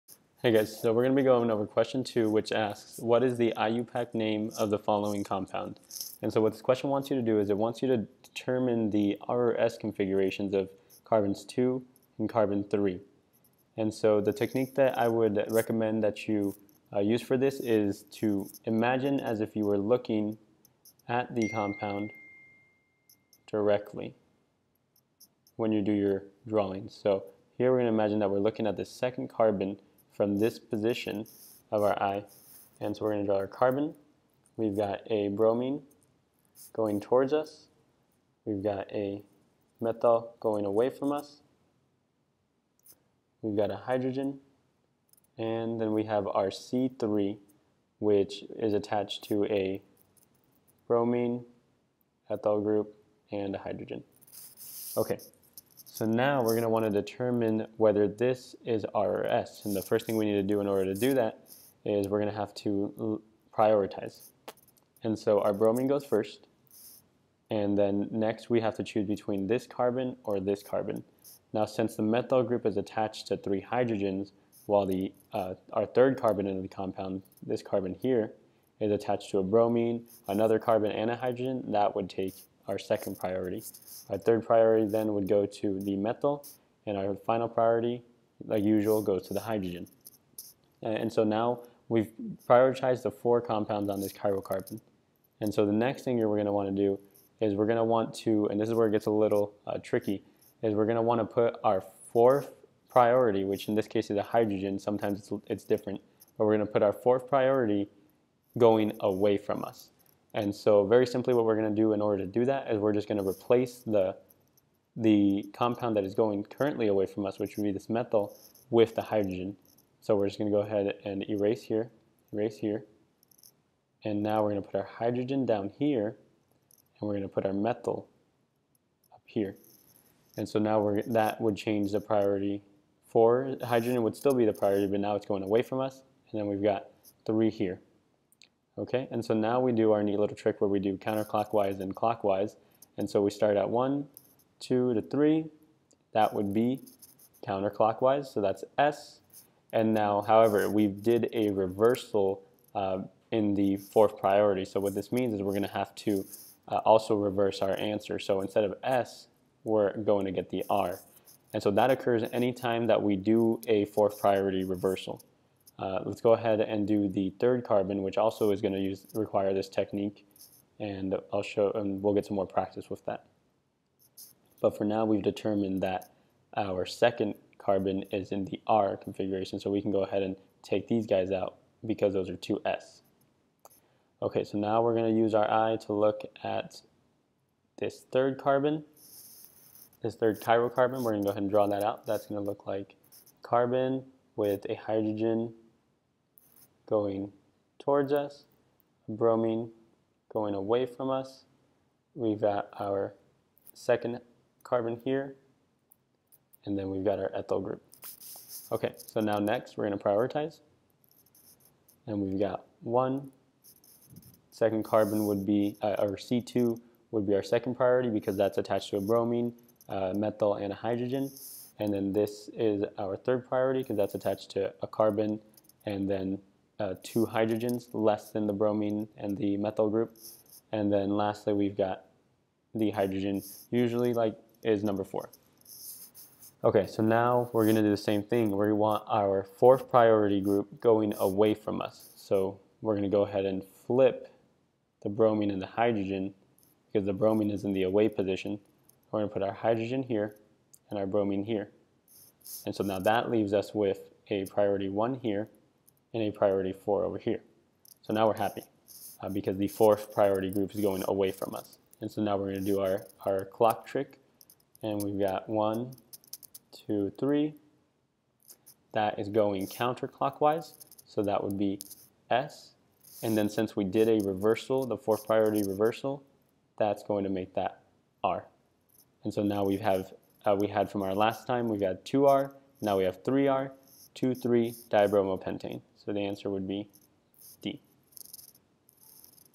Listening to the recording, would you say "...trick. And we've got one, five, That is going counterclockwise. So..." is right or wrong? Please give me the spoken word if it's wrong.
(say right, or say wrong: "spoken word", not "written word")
wrong: "two", not "five".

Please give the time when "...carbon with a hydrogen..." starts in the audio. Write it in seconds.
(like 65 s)
193 s.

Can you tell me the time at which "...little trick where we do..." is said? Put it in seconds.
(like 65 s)
140 s.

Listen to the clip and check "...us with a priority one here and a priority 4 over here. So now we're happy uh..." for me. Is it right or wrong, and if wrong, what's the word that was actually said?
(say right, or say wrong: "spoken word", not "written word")
right.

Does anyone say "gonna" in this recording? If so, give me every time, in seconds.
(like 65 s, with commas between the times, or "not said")
237 s, 242 s, 249 s.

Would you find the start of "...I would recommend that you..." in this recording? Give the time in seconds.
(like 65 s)
14 s.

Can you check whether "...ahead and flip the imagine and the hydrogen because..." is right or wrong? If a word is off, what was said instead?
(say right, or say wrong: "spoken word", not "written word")
wrong: "bromine", not "imagine".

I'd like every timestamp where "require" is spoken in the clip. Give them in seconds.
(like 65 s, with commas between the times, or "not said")
169 s.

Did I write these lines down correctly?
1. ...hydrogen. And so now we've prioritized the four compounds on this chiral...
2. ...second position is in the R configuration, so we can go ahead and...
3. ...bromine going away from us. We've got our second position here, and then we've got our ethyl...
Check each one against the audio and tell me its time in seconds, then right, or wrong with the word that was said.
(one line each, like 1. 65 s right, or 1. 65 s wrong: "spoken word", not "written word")
1. 89 s right
2. 176 s wrong: "carbon", not "position"
3. 199 s wrong: "carbon", not "position".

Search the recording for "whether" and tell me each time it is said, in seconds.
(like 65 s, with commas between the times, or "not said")
57 s.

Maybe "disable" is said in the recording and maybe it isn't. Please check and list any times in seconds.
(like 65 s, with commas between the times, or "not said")
not said.